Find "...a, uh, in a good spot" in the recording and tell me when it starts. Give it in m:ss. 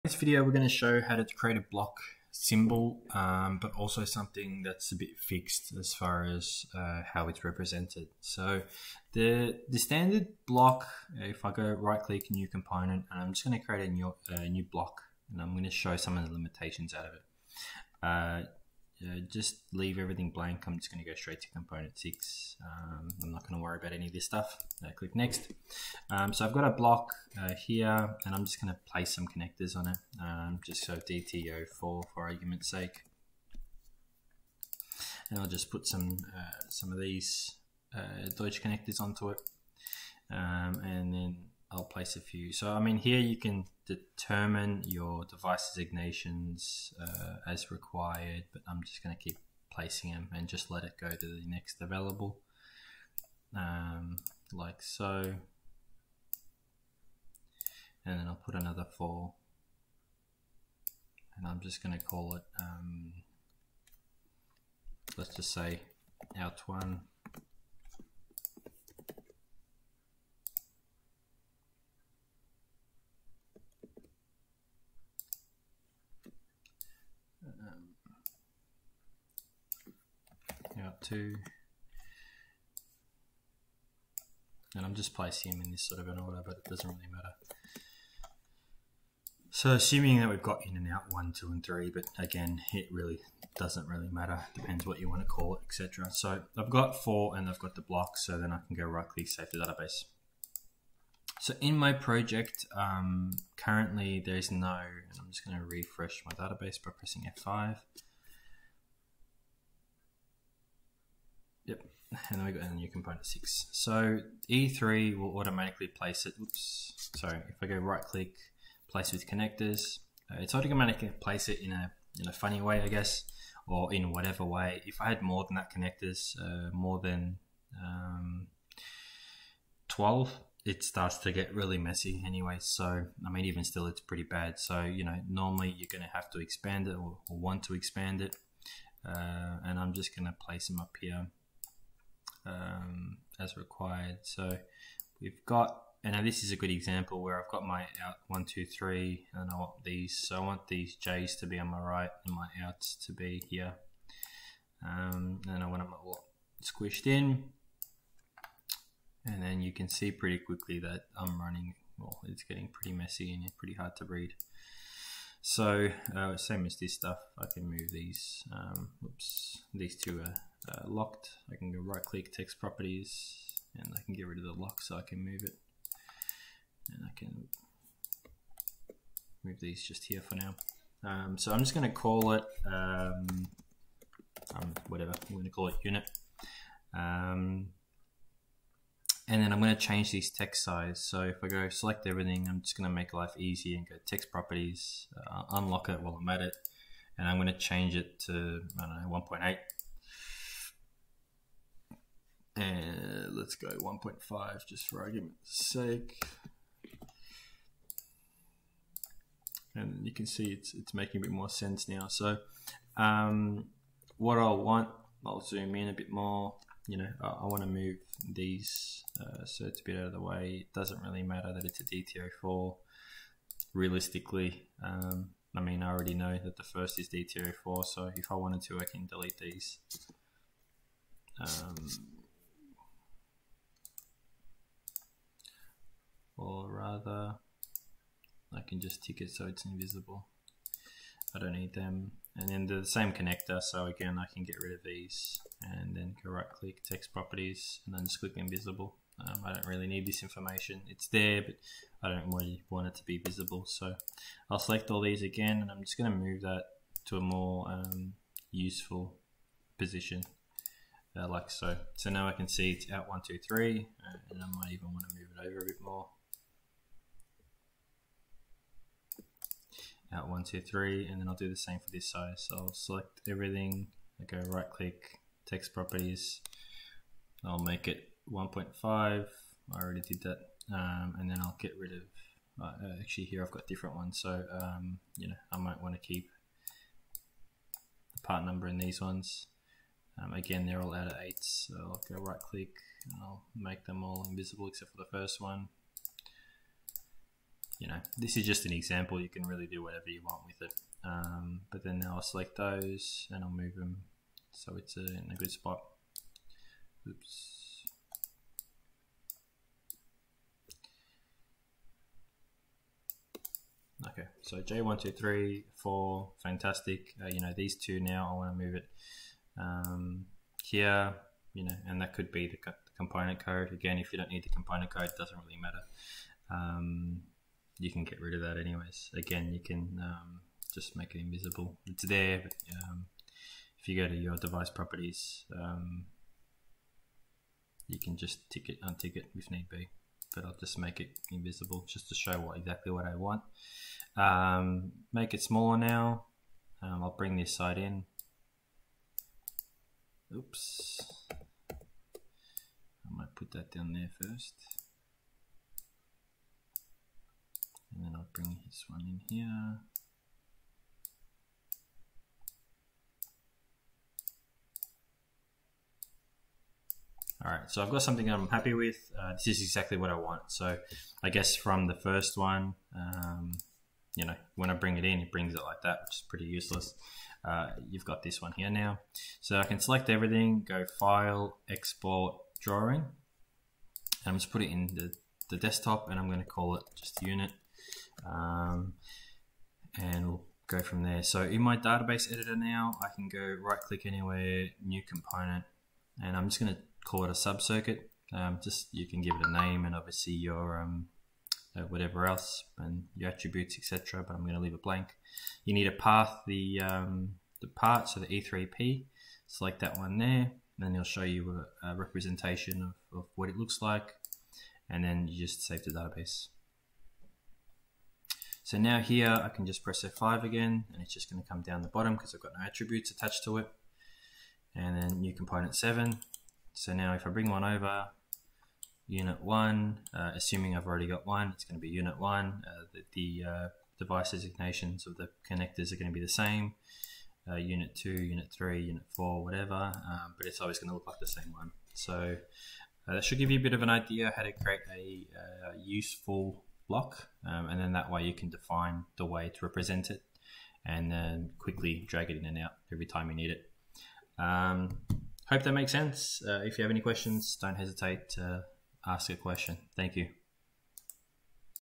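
5:04.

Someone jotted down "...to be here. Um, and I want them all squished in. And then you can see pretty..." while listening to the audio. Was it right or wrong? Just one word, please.
right.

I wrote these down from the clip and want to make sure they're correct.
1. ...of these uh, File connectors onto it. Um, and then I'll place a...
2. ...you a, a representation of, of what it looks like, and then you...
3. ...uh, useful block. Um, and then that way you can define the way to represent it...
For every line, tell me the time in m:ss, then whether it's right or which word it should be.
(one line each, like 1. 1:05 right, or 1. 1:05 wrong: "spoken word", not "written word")
1. 0:36 wrong: "Deutsch", not "File"
2. 6:51 right
3. 7:25 right.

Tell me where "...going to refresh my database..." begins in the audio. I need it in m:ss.
1:45.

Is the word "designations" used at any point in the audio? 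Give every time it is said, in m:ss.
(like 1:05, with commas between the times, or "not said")
0:45, 7:14.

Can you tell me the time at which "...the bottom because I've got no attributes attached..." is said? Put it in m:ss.
7:01.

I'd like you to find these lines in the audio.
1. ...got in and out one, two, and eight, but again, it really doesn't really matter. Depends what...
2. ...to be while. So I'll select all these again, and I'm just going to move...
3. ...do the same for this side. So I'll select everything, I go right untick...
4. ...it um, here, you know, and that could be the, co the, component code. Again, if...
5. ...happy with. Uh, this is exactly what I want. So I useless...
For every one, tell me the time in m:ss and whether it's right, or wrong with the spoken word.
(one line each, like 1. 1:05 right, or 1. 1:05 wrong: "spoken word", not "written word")
1. 1:30 wrong: "three", not "eight"
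2. 4:12 wrong: "visible", not "while"
3. 4:31 wrong: "click", not "untick"
4. 5:18 right
5. 6:08 wrong: "guess", not "useless".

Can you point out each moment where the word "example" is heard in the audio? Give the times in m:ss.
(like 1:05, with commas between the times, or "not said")
2:26, 4:58.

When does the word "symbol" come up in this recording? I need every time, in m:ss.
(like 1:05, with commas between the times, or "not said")
0:02.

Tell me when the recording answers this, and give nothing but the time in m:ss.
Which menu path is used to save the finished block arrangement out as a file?
6:20.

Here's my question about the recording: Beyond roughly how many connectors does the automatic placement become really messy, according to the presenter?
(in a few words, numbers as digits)
12.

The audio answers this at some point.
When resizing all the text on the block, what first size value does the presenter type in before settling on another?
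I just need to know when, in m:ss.
3:19.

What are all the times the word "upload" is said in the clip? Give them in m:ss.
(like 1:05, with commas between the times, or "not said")
not said.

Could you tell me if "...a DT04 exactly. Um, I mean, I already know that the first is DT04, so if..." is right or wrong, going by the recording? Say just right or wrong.
wrong.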